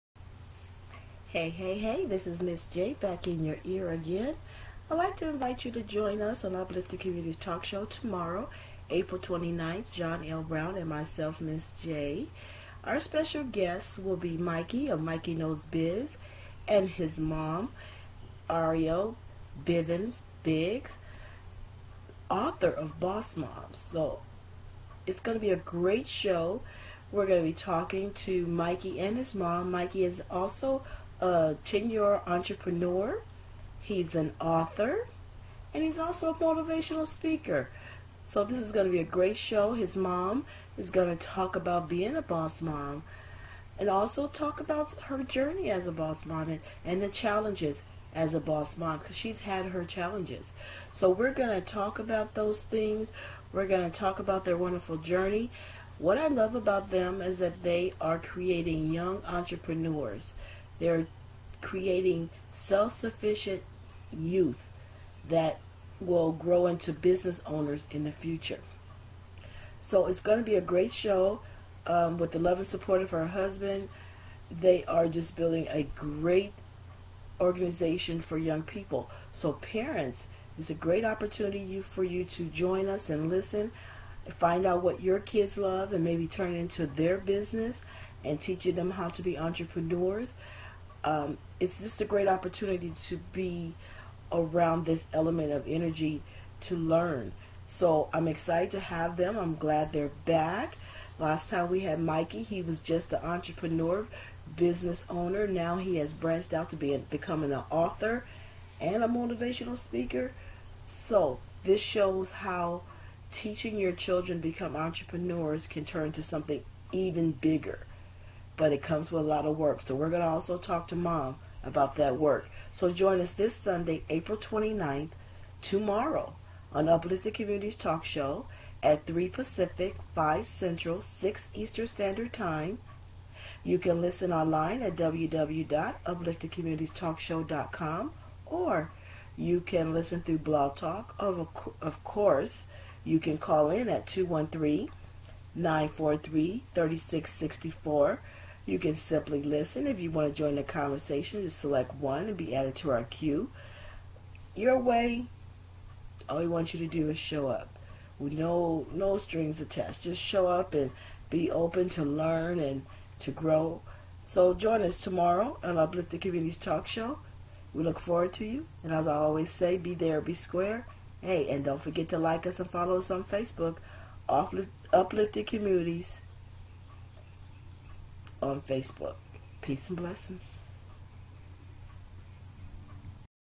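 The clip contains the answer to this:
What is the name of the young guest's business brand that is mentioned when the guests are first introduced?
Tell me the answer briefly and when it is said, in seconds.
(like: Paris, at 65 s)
Mikey Knows Biz, at 15 s.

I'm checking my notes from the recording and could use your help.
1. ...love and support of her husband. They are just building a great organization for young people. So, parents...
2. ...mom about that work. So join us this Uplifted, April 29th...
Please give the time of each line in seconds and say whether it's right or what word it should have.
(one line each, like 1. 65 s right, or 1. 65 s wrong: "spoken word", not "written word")
1. 72 s right
2. 120 s wrong: "Sunday", not "Uplifted".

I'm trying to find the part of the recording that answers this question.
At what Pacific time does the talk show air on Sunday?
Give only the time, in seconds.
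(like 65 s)
129 s.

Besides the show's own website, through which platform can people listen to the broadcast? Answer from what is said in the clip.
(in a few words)
Blog Talk.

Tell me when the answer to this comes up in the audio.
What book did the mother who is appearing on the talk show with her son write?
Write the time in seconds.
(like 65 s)
22 s.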